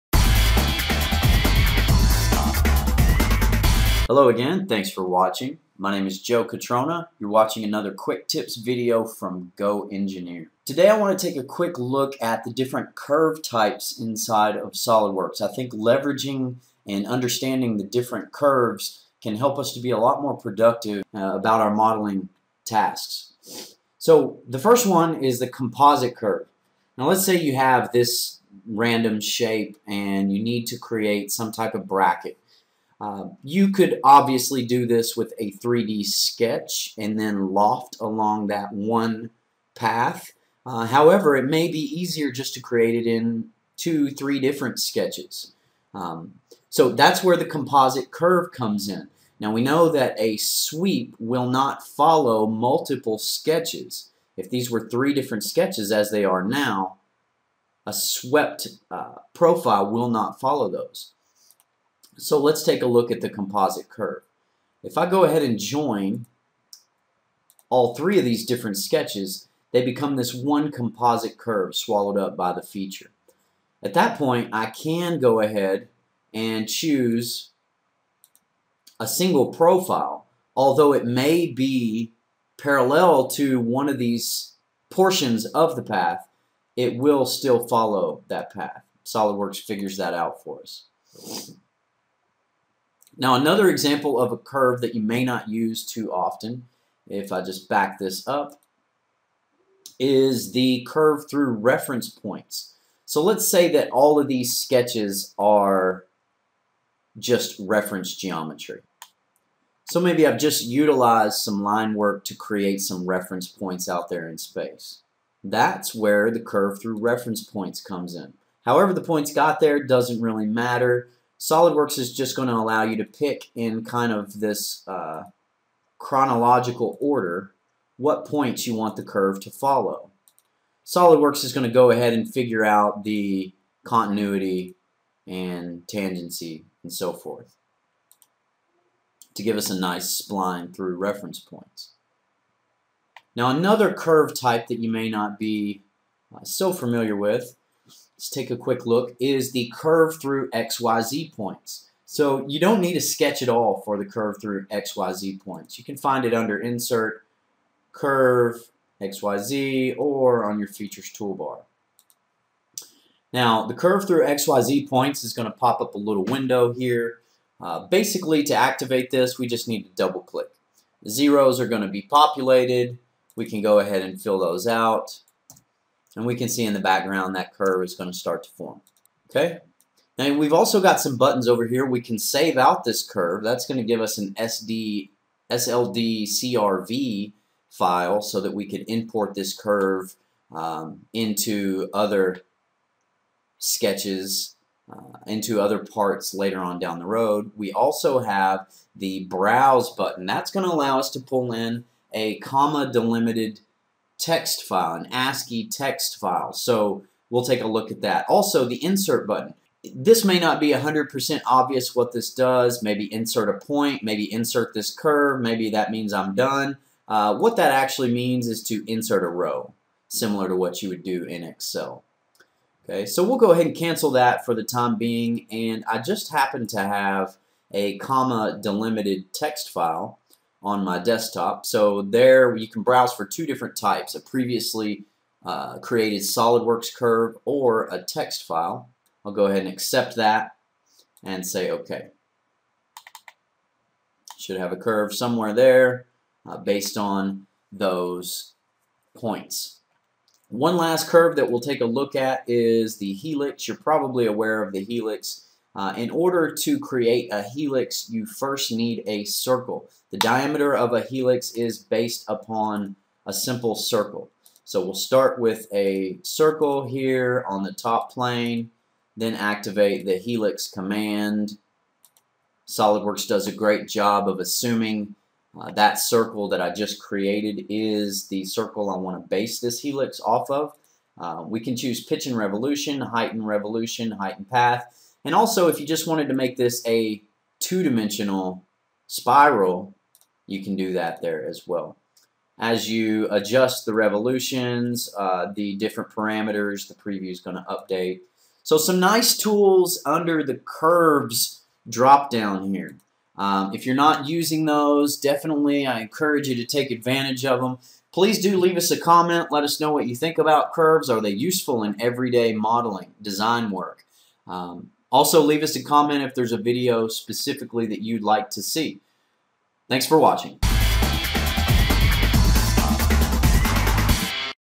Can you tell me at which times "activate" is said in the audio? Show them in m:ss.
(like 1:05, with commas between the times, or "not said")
2:48, 4:29.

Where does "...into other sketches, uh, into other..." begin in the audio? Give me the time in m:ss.
3:11.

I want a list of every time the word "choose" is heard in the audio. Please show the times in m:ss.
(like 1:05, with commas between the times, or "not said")
1:16, 4:41.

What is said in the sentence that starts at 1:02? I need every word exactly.
So let's take a look at the composite curve.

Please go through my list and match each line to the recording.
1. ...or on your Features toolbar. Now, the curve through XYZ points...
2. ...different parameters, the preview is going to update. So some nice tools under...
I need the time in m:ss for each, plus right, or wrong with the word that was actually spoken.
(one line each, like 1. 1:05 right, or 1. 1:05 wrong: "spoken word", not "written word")
1. 2:39 right
2. 4:55 right.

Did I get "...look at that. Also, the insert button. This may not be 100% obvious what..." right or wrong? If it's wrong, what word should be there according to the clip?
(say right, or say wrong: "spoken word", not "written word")
right.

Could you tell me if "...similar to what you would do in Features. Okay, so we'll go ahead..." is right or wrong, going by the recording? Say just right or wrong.
wrong.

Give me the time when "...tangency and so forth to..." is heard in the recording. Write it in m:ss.
2:15.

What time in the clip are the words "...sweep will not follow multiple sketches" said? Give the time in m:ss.
0:50.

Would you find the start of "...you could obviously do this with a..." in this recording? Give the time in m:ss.
0:33.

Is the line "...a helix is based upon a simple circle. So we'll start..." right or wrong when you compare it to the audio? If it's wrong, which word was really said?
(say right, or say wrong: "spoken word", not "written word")
right.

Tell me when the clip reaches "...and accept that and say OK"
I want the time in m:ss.
3:59.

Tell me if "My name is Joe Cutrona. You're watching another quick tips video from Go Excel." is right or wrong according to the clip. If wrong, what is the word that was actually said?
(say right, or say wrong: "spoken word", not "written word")
wrong: "Engineer", not "Excel".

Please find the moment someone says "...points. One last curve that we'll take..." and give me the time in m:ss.
4:09.